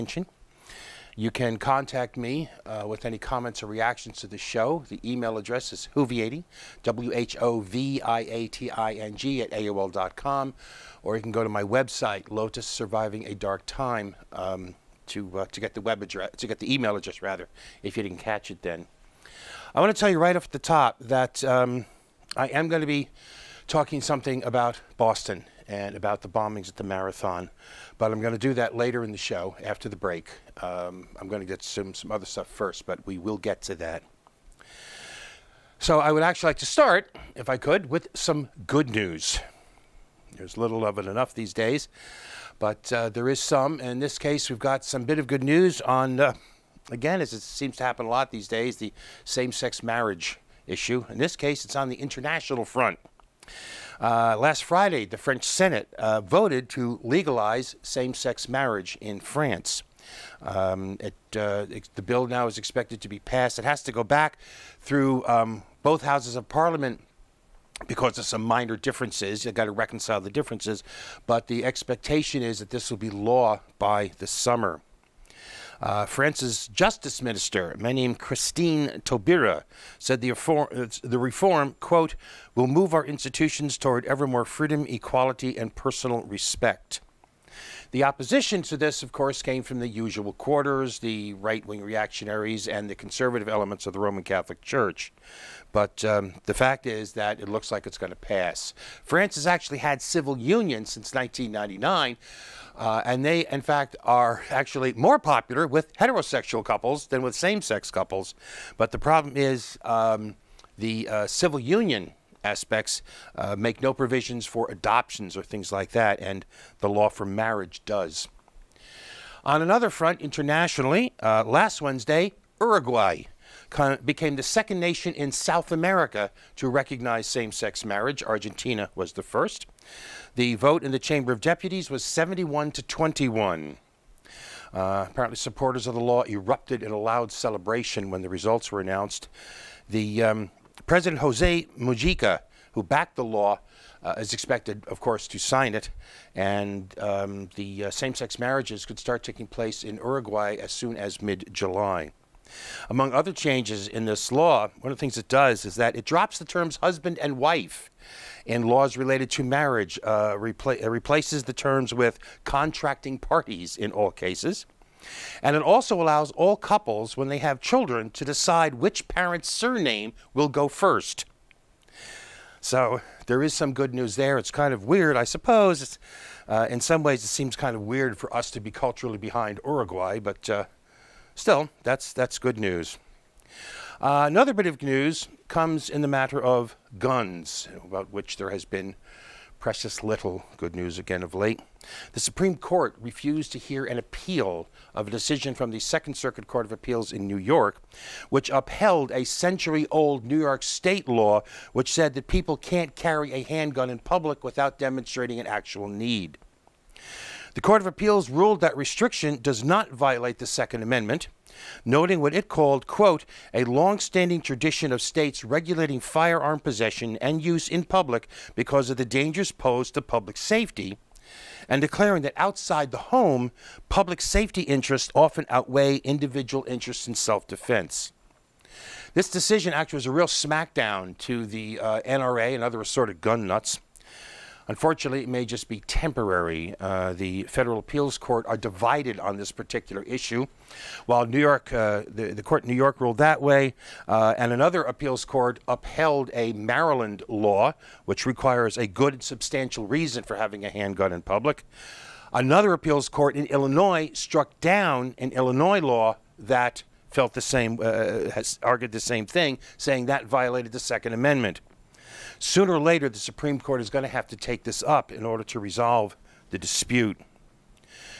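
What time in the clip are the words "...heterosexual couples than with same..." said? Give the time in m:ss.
1:45.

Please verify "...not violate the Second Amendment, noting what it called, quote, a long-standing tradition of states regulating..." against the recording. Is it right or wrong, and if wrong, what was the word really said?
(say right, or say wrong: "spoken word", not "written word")
right.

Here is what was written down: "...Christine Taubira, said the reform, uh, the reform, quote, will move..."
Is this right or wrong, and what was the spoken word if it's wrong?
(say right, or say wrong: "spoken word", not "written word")
right.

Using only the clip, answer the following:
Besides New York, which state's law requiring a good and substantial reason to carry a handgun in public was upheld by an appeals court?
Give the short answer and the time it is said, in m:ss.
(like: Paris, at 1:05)
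Maryland, at 4:06.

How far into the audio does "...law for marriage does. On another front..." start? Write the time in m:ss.
1:56.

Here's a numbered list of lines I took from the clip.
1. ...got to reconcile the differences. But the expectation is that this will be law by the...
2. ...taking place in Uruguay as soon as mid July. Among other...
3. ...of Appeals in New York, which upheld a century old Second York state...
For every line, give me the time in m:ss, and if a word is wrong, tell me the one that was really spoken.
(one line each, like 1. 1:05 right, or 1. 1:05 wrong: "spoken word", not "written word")
1. 1:09 right
2. 2:29 right
3. 3:16 wrong: "New", not "Second".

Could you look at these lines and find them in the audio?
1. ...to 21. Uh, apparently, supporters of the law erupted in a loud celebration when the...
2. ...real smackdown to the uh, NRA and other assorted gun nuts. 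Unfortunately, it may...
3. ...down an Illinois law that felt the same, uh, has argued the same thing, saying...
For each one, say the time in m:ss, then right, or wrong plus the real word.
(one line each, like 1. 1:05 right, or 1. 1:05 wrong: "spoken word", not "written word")
1. 2:12 right
2. 3:50 right
3. 4:14 right.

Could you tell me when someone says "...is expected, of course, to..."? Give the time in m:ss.
2:24.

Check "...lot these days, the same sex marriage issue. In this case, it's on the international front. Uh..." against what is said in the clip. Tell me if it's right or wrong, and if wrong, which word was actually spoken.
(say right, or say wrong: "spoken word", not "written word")
right.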